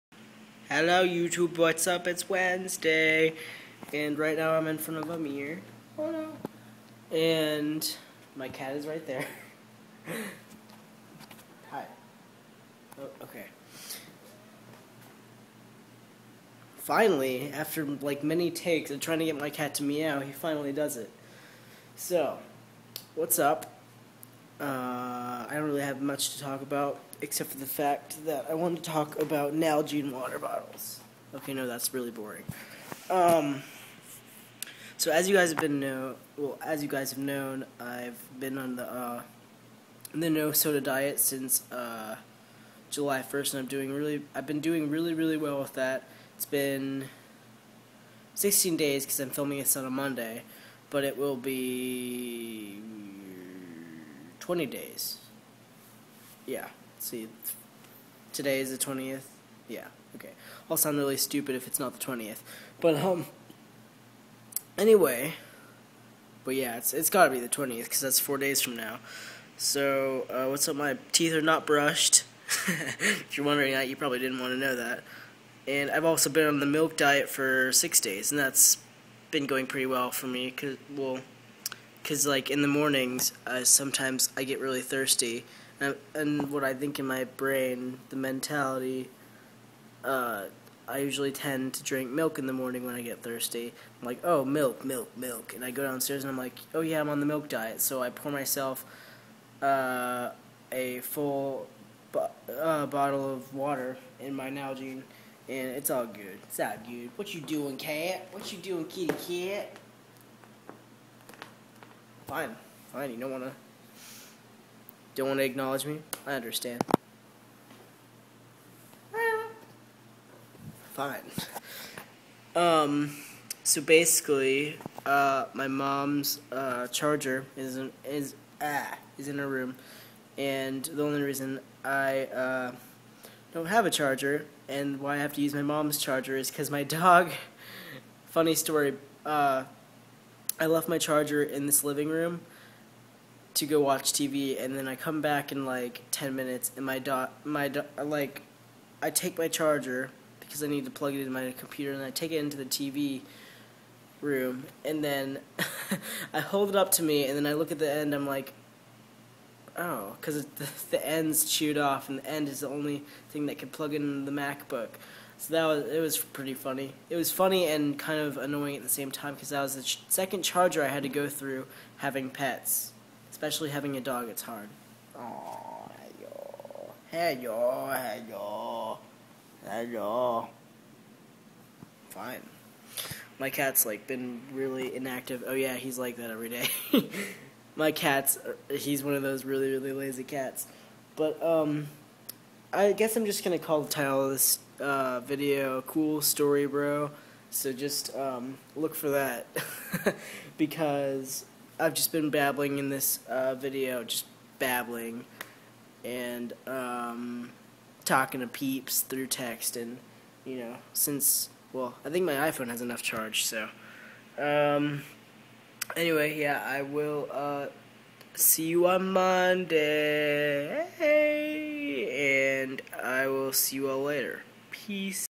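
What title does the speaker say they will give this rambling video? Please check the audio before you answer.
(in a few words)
Cool Story, Bro.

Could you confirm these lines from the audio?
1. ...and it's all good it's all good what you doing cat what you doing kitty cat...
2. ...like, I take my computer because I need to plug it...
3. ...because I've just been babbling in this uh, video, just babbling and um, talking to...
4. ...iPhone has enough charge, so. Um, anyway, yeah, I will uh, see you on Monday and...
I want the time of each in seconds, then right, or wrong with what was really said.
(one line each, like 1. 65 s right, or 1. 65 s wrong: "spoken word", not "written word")
1. 105 s right
2. 147 s wrong: "charger", not "computer"
3. 200 s right
4. 212 s right.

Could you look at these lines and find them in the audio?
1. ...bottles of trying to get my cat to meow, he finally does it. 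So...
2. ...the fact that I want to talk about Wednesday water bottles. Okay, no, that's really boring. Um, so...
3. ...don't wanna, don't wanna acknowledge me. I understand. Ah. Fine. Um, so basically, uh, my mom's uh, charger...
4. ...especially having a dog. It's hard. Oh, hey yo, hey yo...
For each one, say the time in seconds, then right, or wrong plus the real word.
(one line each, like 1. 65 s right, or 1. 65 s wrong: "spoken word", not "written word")
1. 18 s wrong: "takes", not "bottles"
2. 27 s wrong: "Nalgene", not "Wednesday"
3. 113 s right
4. 173 s right.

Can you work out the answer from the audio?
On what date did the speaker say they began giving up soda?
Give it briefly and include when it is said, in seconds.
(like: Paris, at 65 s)
July 1st, at 42 s.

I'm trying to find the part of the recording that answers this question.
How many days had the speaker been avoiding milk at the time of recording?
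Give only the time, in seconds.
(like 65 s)
77 s.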